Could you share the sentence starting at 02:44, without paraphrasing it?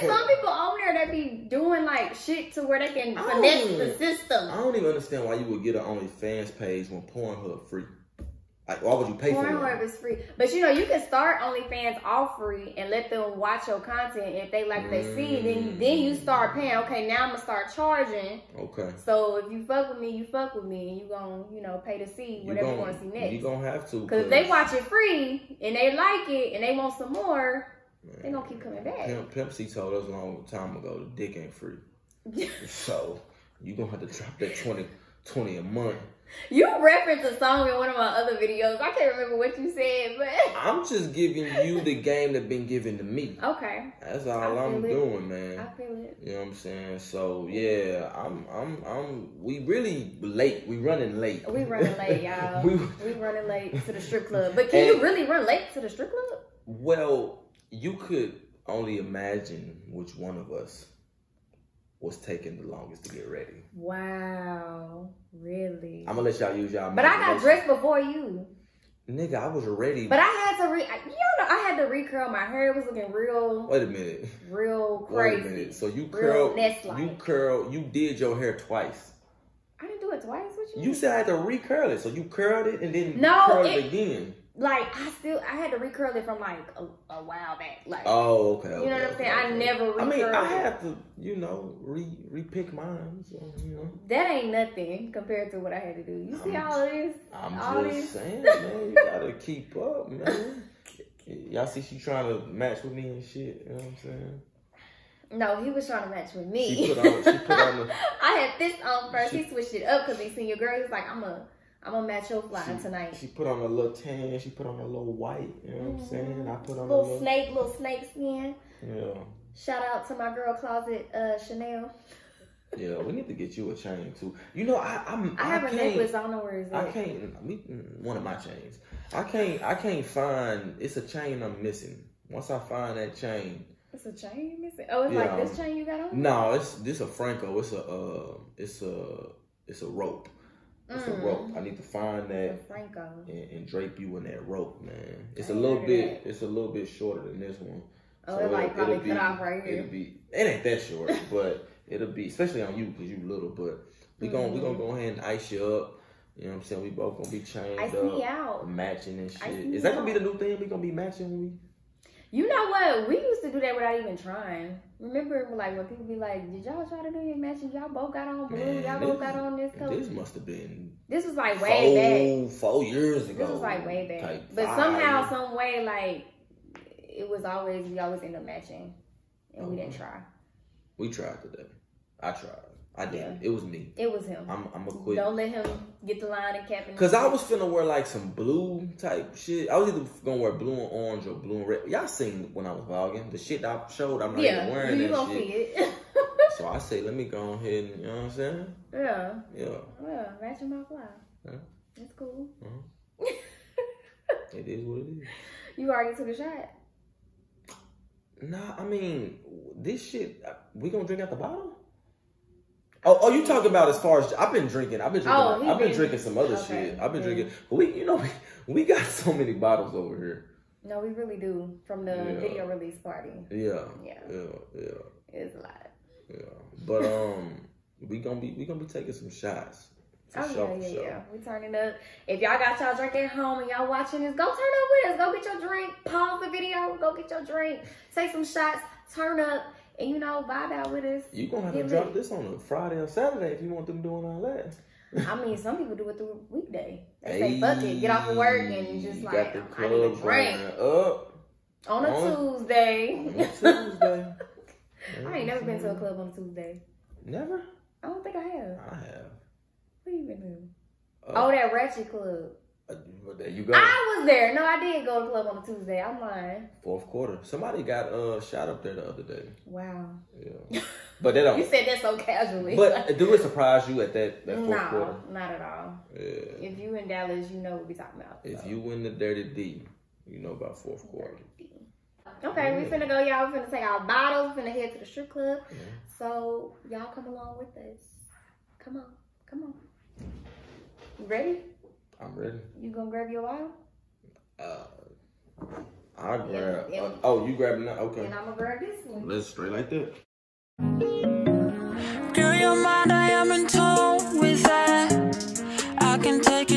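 Remember, like when people be like, "Did y'all try to do your matching?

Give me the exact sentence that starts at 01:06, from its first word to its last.
But I got dressed before you.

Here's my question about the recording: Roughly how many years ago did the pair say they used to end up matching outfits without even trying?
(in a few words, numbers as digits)
4.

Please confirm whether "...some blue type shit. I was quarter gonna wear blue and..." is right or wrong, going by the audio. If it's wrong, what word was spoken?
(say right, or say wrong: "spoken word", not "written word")
wrong: "either", not "quarter".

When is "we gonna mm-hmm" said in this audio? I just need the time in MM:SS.
02:34.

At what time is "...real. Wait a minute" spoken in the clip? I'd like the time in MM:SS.
01:13.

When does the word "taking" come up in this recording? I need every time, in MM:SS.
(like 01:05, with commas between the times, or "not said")
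01:02, 03:48.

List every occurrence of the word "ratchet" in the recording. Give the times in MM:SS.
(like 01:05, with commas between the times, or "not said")
03:20, 04:21.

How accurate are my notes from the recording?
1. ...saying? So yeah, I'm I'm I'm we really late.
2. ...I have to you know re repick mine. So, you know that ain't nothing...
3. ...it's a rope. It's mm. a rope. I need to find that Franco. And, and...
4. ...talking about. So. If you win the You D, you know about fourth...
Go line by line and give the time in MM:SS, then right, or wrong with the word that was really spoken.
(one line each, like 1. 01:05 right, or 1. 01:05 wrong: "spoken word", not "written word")
1. 00:46 right
2. 01:30 right
3. 02:19 right
4. 04:37 wrong: "Dirty", not "You".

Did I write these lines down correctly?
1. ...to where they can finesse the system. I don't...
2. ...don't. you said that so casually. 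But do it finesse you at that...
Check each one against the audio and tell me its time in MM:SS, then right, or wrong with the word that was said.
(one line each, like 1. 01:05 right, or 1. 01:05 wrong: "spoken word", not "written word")
1. 00:02 right
2. 04:31 wrong: "surprise", not "finesse".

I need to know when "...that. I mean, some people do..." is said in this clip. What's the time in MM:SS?
04:04.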